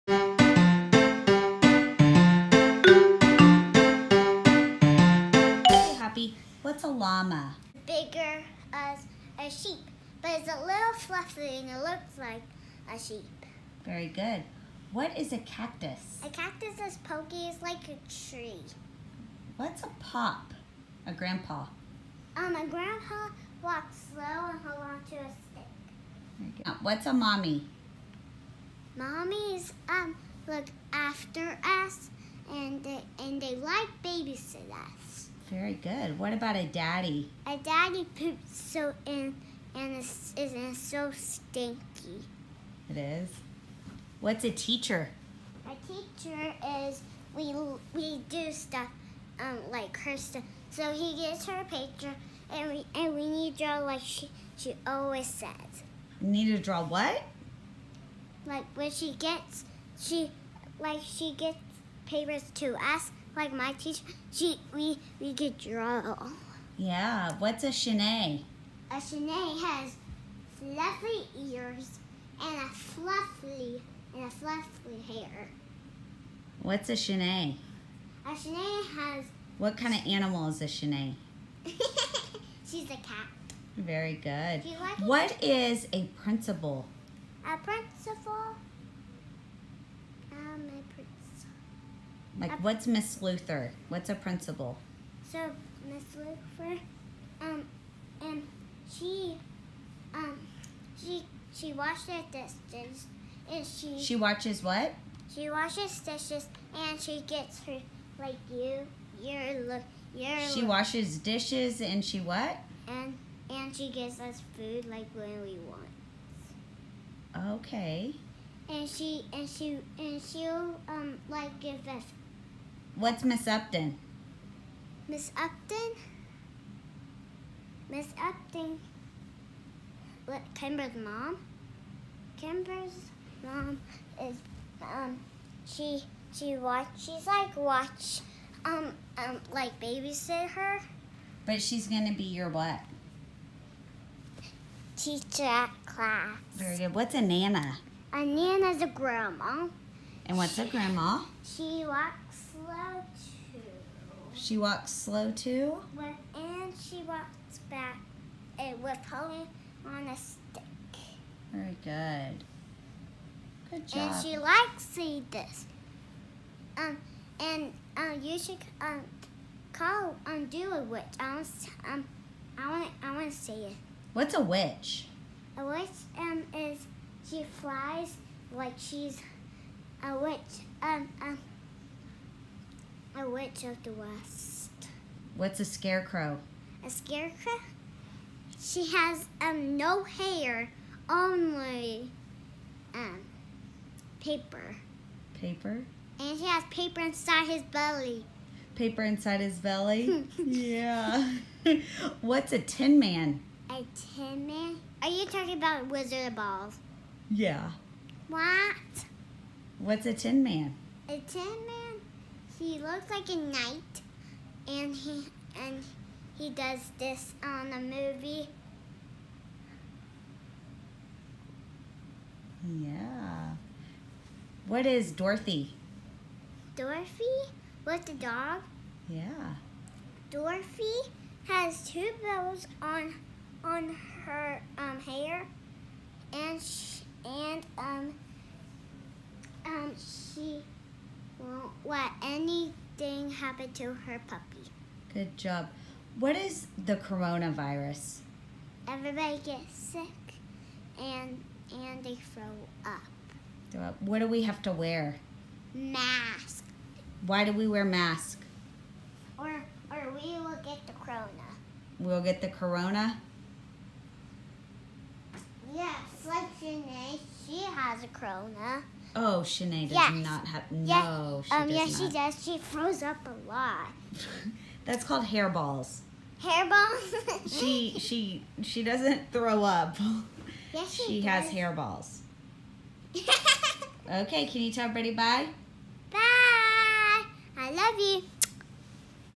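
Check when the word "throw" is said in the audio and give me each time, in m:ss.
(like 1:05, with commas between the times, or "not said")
4:12, 4:32, 4:39.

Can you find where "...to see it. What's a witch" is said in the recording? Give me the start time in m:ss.
2:53.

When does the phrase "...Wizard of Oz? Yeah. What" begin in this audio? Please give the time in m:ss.
3:25.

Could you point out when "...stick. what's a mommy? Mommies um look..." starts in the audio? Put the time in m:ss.
0:25.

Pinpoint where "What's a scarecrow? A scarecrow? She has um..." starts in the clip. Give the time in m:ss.
3:05.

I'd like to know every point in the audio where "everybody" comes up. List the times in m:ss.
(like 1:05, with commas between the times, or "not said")
4:08, 4:44.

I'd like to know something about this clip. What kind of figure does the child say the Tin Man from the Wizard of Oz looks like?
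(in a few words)
a knight.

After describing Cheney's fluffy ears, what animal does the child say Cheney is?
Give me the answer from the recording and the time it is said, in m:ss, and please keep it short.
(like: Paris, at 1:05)
cat, at 1:22.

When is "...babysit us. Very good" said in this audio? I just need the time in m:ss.
0:34.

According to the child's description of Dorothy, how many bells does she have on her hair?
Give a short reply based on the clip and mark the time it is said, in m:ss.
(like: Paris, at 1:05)
2, at 3:51.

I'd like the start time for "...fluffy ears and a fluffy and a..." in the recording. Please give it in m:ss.
1:10.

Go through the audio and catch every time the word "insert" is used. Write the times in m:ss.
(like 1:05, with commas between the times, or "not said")
not said.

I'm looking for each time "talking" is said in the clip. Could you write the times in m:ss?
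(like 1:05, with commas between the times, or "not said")
3:25.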